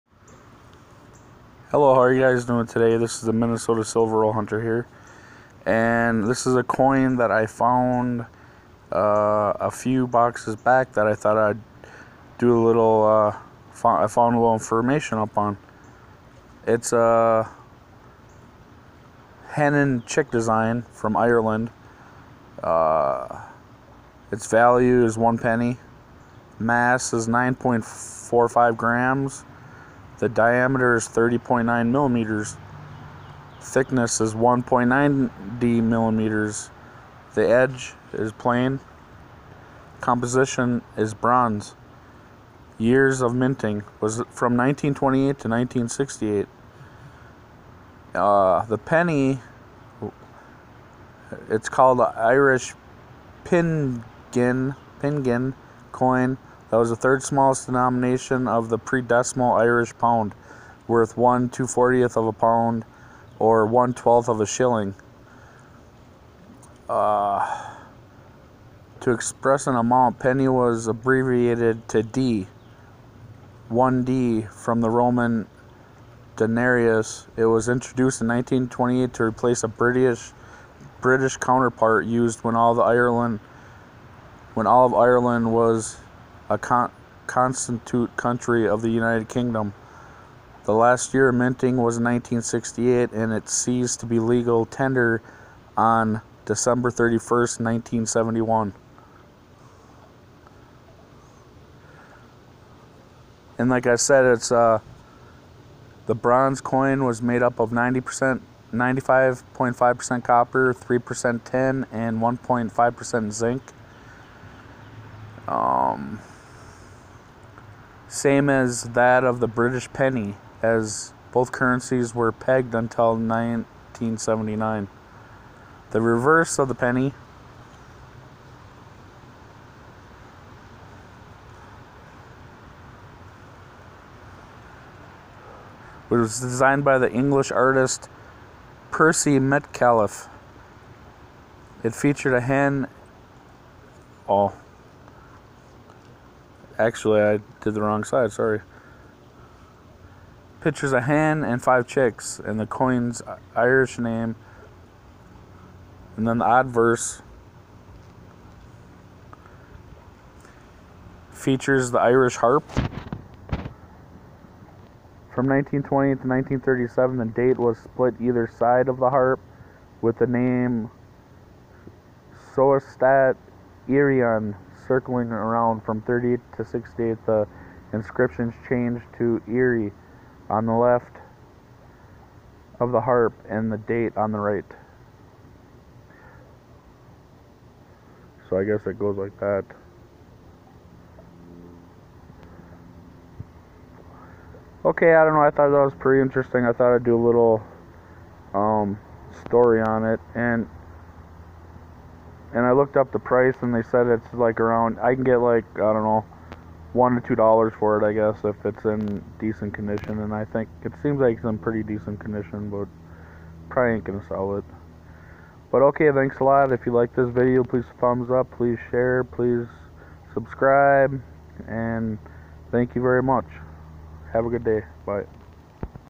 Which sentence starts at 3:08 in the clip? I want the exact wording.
So I guess it goes like that.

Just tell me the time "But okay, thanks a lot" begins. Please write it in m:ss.
3:35.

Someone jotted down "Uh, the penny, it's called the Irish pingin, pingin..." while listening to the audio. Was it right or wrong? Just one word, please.
right.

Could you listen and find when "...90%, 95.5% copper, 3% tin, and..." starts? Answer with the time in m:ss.
1:47.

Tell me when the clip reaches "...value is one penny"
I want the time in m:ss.
0:24.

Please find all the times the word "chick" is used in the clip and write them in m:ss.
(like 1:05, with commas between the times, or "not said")
0:20, 2:31.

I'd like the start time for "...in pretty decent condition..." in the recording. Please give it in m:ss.
3:31.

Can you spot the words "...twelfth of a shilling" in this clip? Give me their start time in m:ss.
1:03.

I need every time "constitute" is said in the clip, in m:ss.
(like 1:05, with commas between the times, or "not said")
1:27.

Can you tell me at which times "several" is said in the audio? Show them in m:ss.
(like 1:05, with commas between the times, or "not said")
not said.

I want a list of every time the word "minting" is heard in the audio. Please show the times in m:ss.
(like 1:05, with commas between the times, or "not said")
0:43, 1:31.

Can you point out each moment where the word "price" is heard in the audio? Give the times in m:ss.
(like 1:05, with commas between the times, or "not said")
3:23.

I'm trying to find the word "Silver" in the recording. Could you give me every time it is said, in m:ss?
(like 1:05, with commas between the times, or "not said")
0:03.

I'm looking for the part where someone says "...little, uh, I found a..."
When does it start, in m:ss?
0:12.